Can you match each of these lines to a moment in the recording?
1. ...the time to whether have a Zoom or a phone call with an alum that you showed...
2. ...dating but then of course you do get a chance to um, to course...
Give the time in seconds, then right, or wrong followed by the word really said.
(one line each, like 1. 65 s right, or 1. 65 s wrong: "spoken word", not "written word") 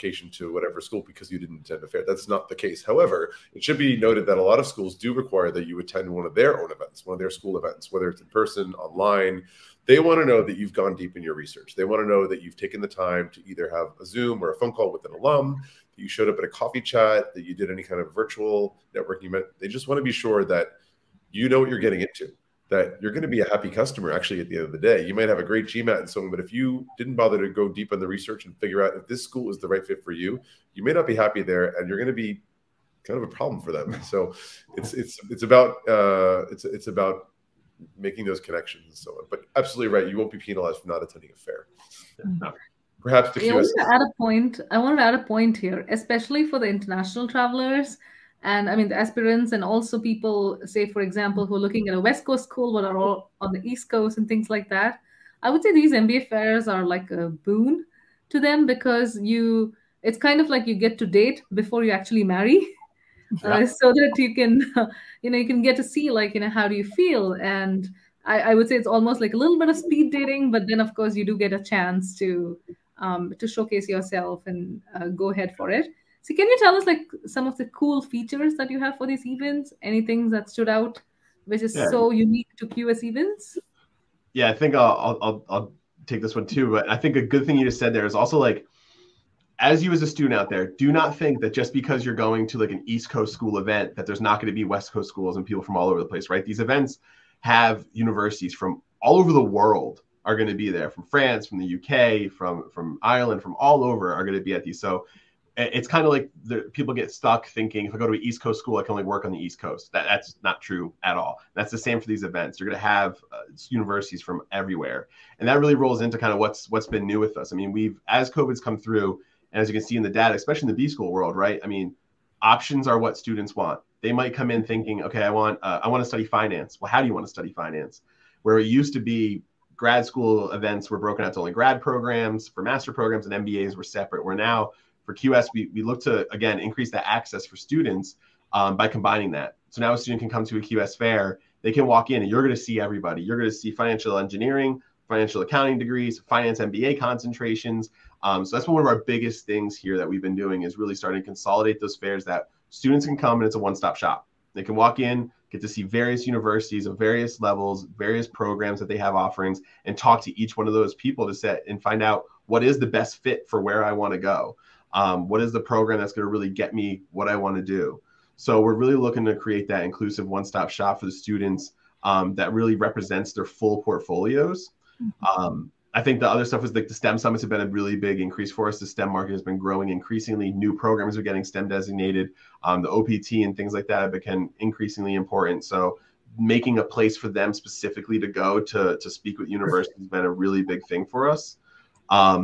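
1. 12 s wrong: "either", not "whether"
2. 70 s wrong: "showcase", not "course".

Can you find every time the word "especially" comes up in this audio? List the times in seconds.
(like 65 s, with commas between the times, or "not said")
45 s, 120 s.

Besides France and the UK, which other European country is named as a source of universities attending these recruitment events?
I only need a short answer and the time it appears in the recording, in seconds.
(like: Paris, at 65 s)
Ireland, at 103 s.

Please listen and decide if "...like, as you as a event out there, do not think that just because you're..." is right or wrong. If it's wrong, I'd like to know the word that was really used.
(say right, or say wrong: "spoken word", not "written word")
wrong: "student", not "event".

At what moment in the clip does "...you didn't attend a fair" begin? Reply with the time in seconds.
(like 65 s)
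1 s.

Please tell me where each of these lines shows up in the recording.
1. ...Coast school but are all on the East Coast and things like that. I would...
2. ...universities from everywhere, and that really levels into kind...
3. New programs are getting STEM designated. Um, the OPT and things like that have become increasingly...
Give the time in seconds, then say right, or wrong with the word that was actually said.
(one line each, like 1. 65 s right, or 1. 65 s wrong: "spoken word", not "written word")
1. 52 s right
2. 113 s wrong: "rolls", not "levels"
3. 180 s right.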